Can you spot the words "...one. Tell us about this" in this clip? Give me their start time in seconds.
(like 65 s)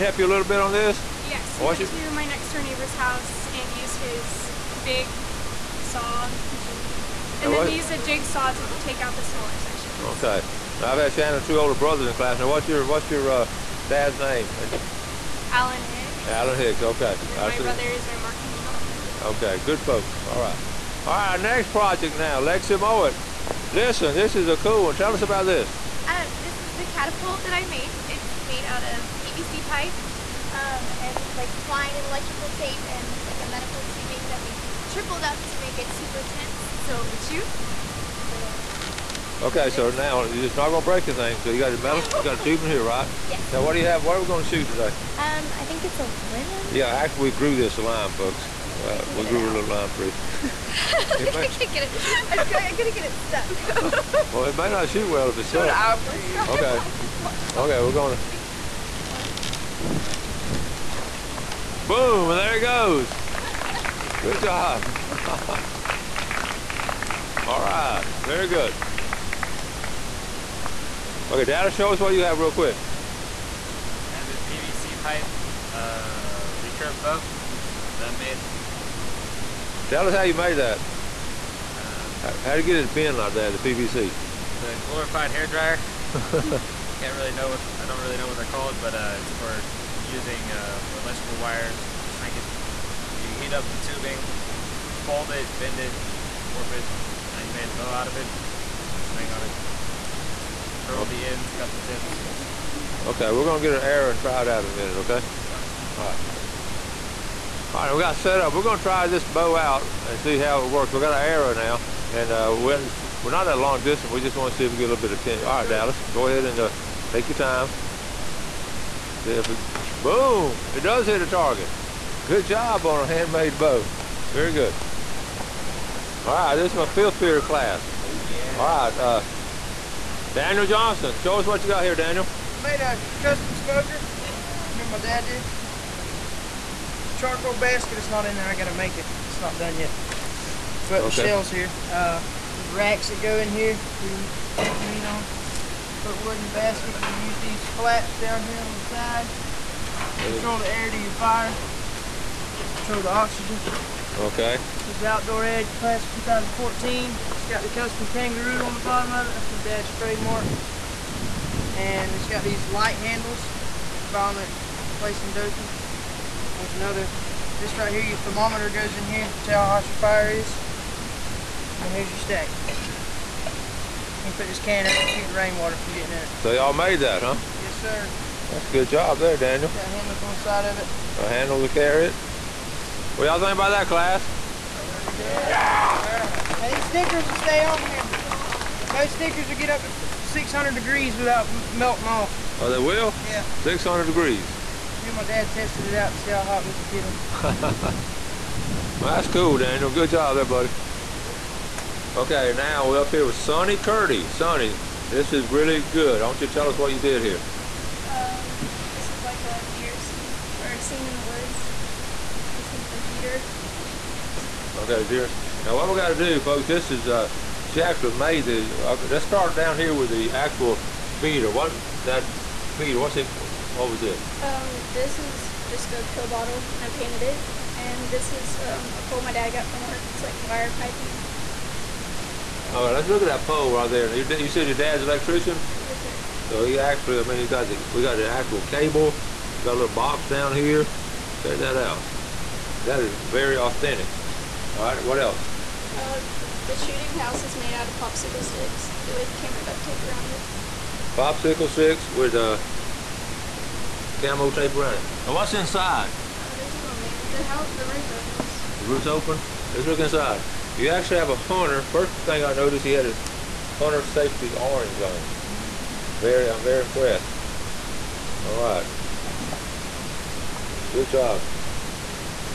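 24 s.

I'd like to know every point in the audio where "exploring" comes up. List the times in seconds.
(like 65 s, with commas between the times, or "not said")
not said.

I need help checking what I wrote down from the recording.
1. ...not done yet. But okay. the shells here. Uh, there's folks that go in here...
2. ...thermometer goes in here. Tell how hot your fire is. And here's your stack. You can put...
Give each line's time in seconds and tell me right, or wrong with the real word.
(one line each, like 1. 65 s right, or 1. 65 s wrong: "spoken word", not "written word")
1. 139 s wrong: "racks", not "folks"
2. 168 s right.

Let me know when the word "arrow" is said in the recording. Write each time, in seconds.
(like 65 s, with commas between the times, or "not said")
103 s, 111 s.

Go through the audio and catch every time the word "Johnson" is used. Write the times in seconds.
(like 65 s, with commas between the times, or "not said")
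130 s.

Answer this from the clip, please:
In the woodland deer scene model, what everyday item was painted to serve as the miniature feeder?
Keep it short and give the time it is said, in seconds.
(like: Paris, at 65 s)
Pill bottle, at 226 s.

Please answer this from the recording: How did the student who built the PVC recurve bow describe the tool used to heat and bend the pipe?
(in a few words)
Glorified hair dryer.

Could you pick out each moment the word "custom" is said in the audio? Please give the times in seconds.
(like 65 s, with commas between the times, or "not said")
133 s, 157 s.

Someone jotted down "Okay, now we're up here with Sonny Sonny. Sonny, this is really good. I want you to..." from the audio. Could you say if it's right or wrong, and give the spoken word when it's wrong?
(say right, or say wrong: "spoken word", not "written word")
wrong: "Curdy", not "Sonny".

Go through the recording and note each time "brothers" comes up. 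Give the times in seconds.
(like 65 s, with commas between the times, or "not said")
11 s, 17 s.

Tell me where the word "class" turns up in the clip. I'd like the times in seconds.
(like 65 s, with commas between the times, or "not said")
12 s, 127 s, 155 s, 183 s.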